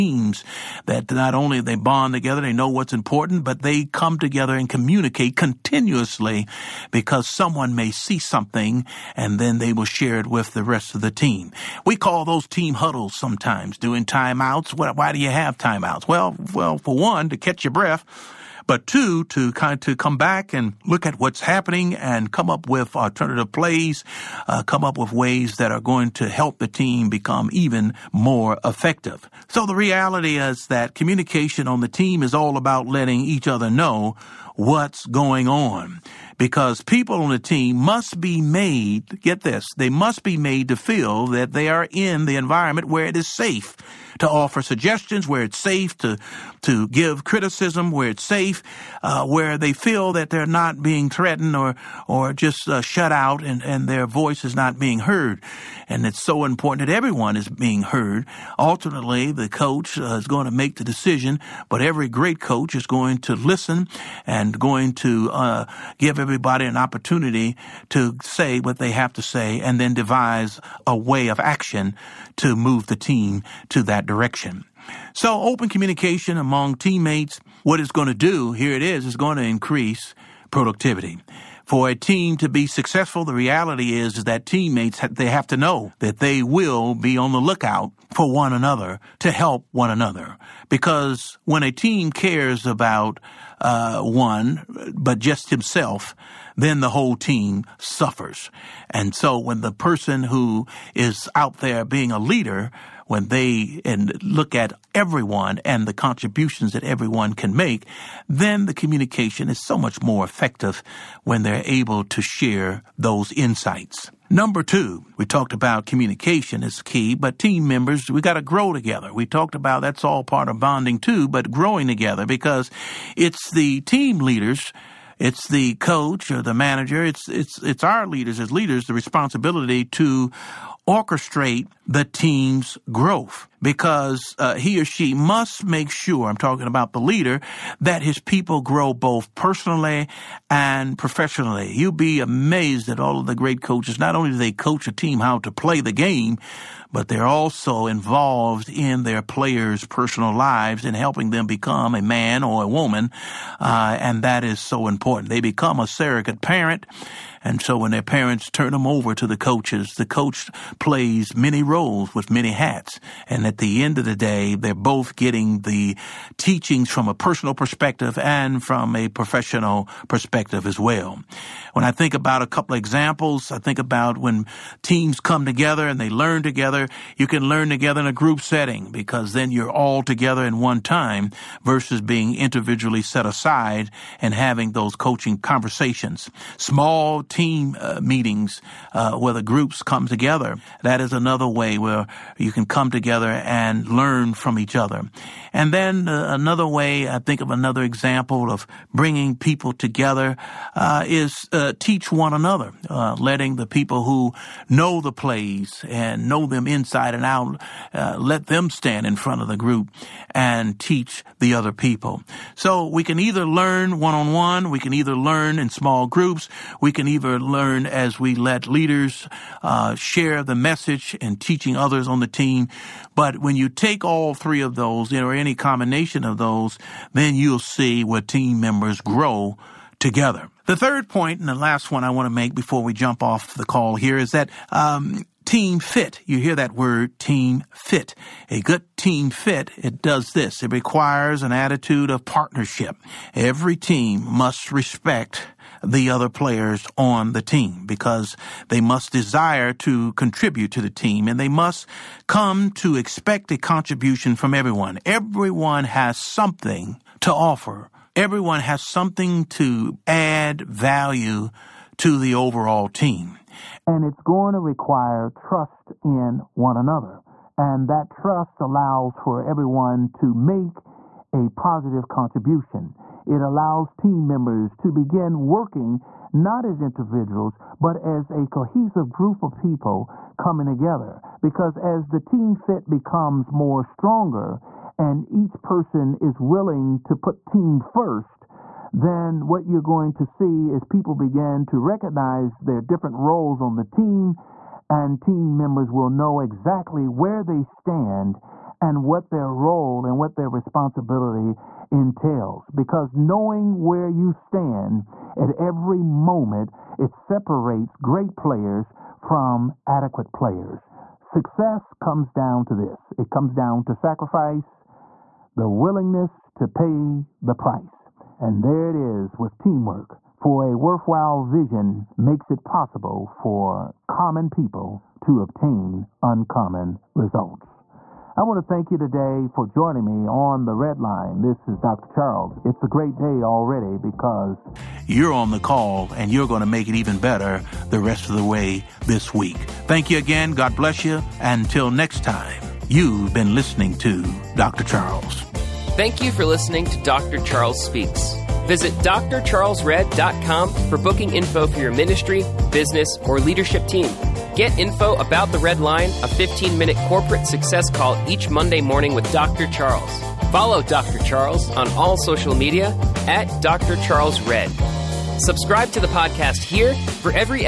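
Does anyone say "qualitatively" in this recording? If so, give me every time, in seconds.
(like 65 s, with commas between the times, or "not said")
not said.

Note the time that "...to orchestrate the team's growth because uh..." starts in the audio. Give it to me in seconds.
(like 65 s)
129 s.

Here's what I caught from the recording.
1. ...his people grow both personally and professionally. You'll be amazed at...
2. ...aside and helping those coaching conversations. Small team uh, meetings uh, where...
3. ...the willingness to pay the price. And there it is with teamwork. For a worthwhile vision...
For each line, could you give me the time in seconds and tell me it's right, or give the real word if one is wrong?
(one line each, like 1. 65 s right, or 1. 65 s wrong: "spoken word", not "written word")
1. 138 s right
2. 183 s wrong: "having", not "helping"
3. 315 s right.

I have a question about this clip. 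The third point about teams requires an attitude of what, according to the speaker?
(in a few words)
partnership.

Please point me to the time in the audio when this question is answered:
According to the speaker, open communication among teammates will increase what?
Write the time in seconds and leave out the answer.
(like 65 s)
80 s.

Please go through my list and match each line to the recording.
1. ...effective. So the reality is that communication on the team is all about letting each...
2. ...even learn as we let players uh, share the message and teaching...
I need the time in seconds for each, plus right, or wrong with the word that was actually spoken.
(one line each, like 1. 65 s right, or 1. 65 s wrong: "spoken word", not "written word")
1. 28 s right
2. 217 s wrong: "leaders", not "players".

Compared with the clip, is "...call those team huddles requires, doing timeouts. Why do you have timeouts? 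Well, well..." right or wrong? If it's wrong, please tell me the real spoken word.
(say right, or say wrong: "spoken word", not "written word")
wrong: "sometimes", not "requires".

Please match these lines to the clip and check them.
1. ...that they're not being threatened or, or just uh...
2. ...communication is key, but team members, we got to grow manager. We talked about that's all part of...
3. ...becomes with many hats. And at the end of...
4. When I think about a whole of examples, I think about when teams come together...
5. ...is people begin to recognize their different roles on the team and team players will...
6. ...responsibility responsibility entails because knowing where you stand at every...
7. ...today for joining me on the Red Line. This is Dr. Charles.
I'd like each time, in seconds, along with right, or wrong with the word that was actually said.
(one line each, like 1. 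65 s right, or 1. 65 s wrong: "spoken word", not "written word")
1. 50 s right
2. 115 s wrong: "together", not "manager"
3. 161 s wrong: "roles", not "becomes"
4. 171 s wrong: "couple", not "whole"
5. 290 s wrong: "members", not "players"
6. 300 s right
7. 328 s right.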